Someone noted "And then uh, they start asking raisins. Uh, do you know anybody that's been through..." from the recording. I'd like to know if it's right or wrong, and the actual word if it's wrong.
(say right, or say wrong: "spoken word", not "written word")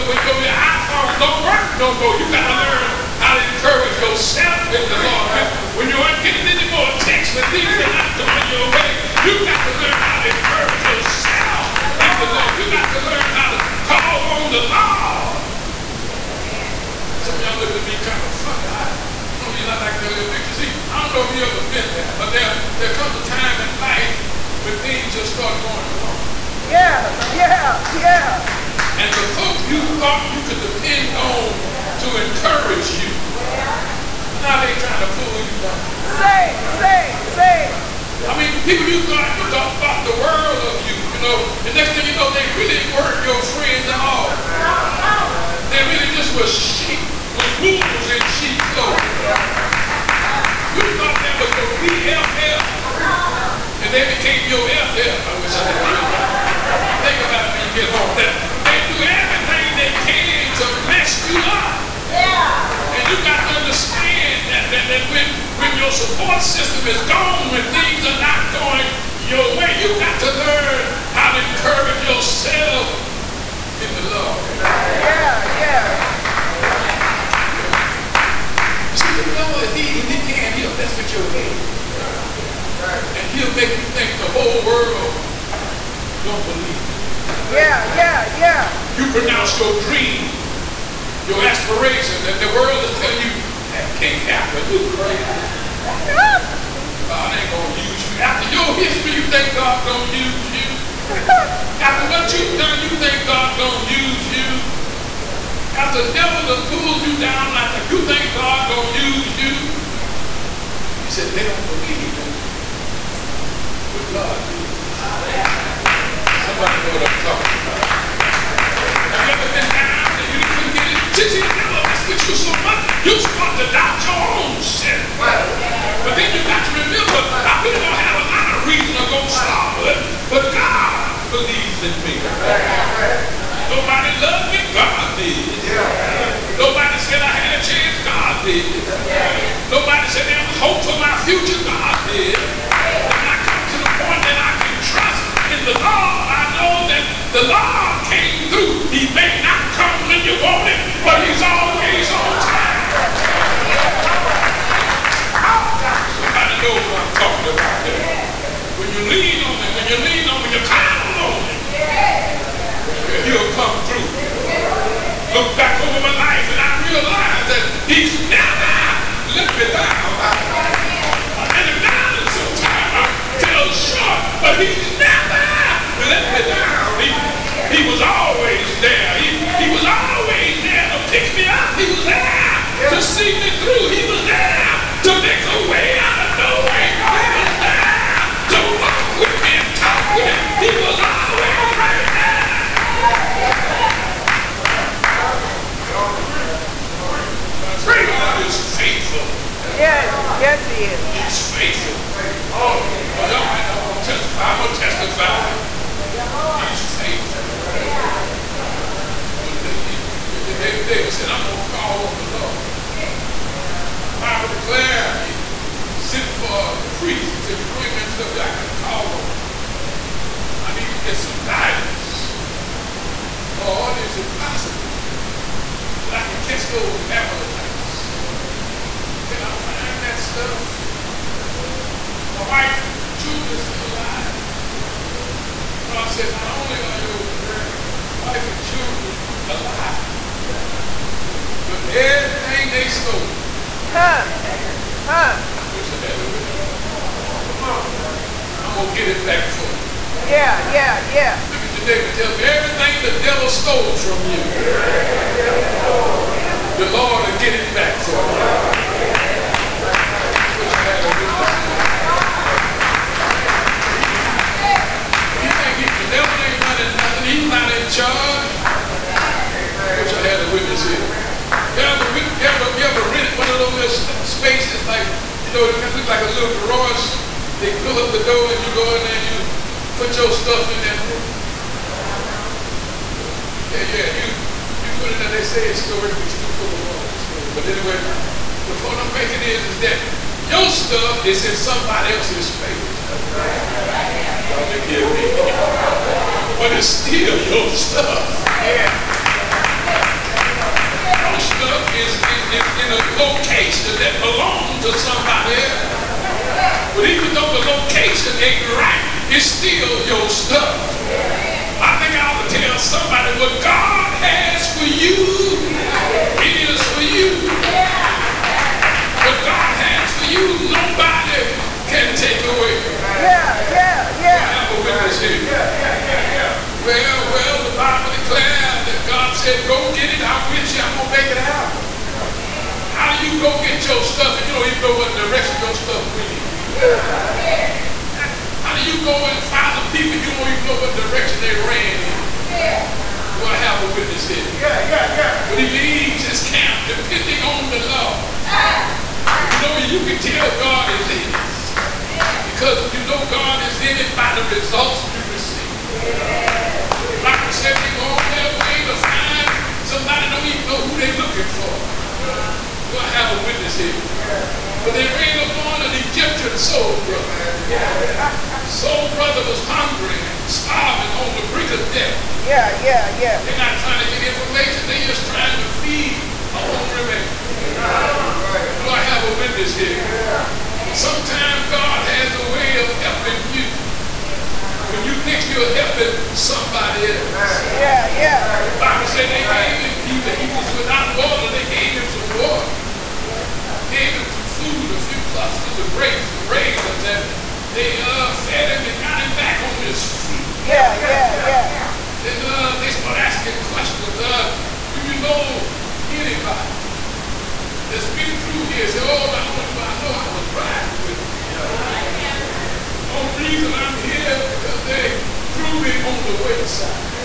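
wrong: "questions", not "raisins".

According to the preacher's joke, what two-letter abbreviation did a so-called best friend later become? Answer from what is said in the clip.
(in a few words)
FF.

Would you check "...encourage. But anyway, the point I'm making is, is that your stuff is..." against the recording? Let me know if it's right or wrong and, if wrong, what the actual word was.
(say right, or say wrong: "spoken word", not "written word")
wrong: "storage", not "encourage".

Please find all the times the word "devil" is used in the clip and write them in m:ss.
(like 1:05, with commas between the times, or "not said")
1:19, 1:46.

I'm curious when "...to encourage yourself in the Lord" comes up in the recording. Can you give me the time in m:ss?
1:11.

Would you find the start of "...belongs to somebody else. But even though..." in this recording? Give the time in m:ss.
5:04.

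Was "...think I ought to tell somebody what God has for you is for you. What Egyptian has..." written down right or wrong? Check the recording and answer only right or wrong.
wrong.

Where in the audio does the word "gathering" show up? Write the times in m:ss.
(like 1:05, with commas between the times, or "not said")
not said.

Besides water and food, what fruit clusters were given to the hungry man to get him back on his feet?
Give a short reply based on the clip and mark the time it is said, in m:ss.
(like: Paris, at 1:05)
grapes, at 6:35.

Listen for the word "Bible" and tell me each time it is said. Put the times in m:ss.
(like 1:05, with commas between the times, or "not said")
5:57, 6:28.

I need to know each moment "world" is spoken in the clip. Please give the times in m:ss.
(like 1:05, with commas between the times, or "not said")
0:40, 1:24, 1:32.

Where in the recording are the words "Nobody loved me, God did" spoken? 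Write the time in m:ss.
2:13.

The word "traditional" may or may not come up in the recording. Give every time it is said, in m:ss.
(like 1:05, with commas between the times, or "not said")
not said.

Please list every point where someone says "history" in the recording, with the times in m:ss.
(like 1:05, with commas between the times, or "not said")
1:38.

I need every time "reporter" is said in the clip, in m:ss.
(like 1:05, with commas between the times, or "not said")
not said.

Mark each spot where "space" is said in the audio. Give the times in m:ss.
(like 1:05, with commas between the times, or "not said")
4:52.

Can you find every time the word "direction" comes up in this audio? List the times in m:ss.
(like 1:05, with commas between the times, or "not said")
5:35, 5:40.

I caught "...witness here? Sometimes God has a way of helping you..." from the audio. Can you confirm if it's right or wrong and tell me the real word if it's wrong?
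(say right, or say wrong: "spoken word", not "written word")
right.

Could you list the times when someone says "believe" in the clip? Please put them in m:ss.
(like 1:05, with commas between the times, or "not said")
1:26, 1:51.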